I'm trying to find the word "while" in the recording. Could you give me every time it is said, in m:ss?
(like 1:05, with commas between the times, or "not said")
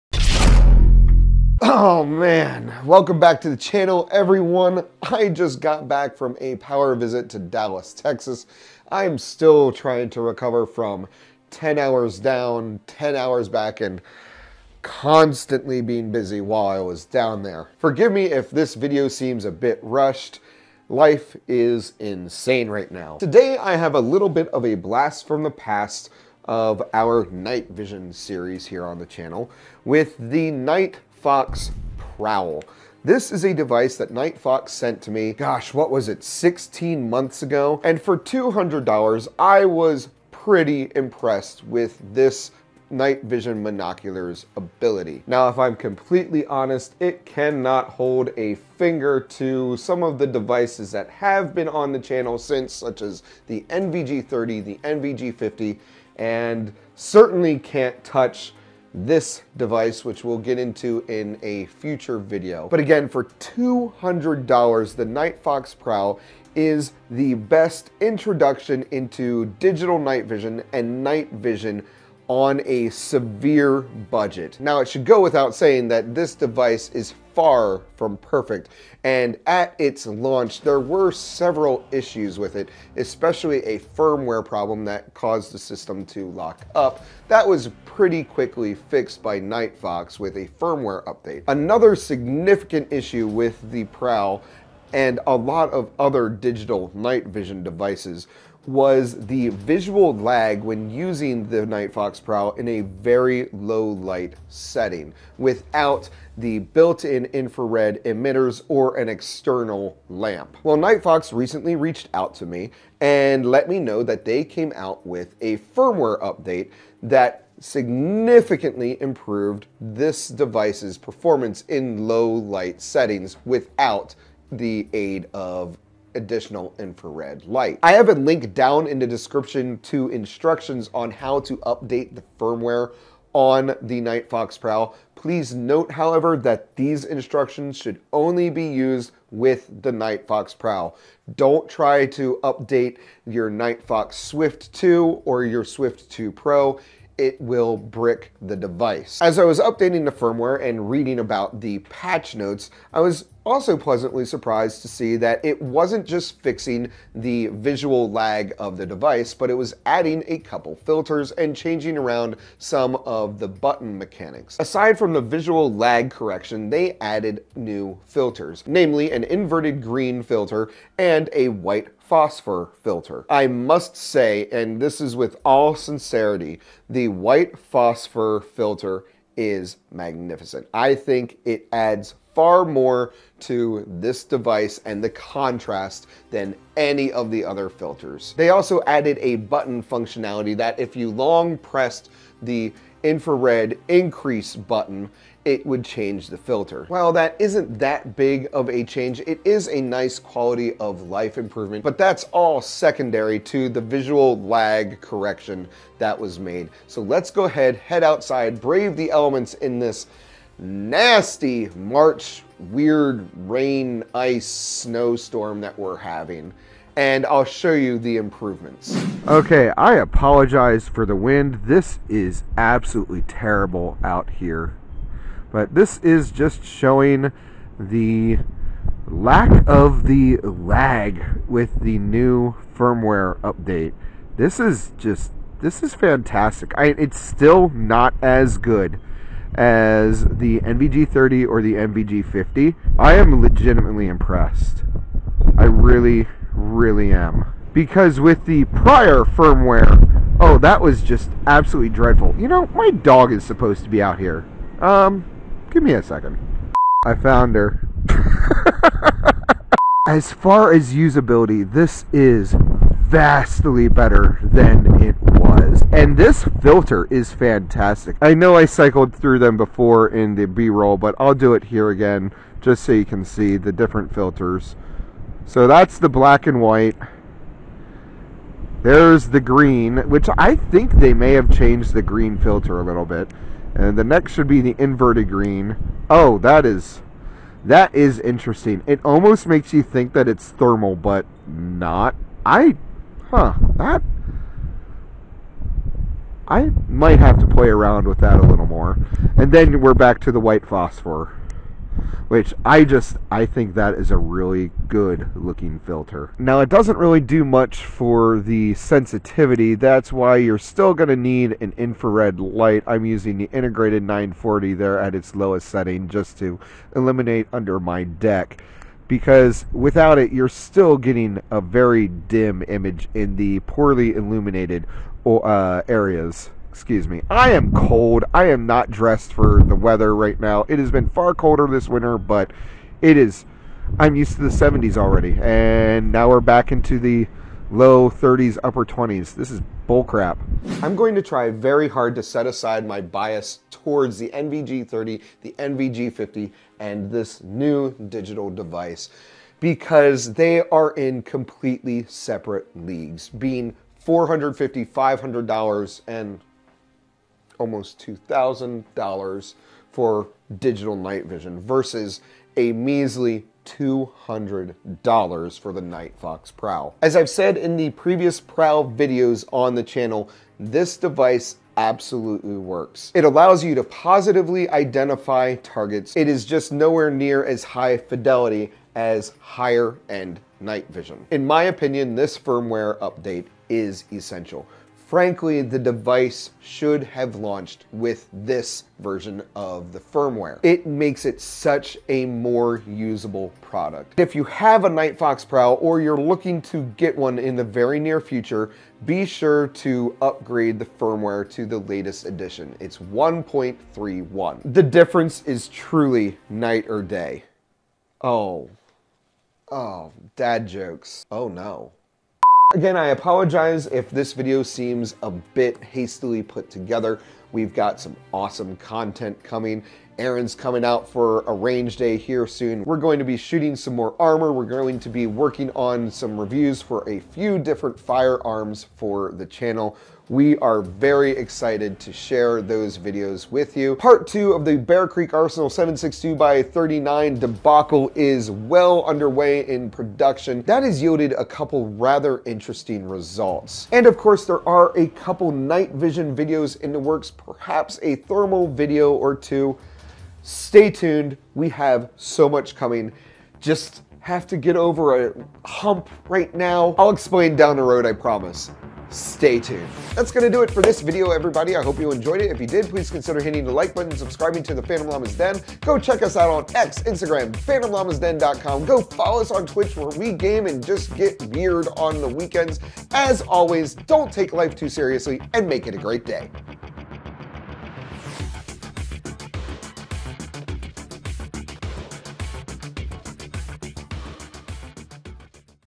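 0:16, 3:16.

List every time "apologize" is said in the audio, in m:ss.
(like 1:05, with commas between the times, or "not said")
3:39, 6:53.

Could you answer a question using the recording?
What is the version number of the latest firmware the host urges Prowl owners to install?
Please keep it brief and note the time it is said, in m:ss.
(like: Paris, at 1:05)
1.31, at 6:42.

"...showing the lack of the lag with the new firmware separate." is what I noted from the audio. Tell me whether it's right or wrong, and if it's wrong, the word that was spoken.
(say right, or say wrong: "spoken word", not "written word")
wrong: "update", not "separate".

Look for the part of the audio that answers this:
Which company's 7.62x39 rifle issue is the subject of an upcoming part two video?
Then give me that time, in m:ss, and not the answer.
7:14.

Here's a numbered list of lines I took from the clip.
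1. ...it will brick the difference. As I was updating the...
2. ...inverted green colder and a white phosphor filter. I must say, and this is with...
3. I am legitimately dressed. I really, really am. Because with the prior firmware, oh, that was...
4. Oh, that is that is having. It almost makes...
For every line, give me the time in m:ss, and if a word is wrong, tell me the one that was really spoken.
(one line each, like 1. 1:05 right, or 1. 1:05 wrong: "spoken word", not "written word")
1. 2:27 wrong: "device", not "difference"
2. 2:49 wrong: "filter", not "colder"
3. 4:02 wrong: "impressed", not "dressed"
4. 4:46 wrong: "interesting", not "having".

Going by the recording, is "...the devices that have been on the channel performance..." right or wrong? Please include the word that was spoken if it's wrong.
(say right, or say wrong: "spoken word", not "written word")
wrong: "since", not "performance".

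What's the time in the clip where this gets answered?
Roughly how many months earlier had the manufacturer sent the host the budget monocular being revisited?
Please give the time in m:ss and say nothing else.
0:36.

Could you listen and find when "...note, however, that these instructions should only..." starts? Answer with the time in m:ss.
2:15.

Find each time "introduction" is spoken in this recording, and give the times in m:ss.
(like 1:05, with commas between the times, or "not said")
1:08.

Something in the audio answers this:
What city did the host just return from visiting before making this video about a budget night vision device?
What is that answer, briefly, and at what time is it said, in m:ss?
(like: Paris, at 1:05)
Dallas, at 0:07.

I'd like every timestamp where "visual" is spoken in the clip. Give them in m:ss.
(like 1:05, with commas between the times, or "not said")
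1:39, 2:37, 2:45, 3:23.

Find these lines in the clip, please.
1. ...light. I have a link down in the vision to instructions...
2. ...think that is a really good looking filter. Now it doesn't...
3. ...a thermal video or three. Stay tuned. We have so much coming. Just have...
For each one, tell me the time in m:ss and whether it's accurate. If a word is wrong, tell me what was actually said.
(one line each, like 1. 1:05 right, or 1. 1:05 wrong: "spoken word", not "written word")
1. 2:07 wrong: "description", not "vision"
2. 5:03 right
3. 7:28 wrong: "two", not "three".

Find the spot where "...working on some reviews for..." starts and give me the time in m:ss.
7:05.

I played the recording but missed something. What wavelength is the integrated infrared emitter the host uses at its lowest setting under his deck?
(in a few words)
940.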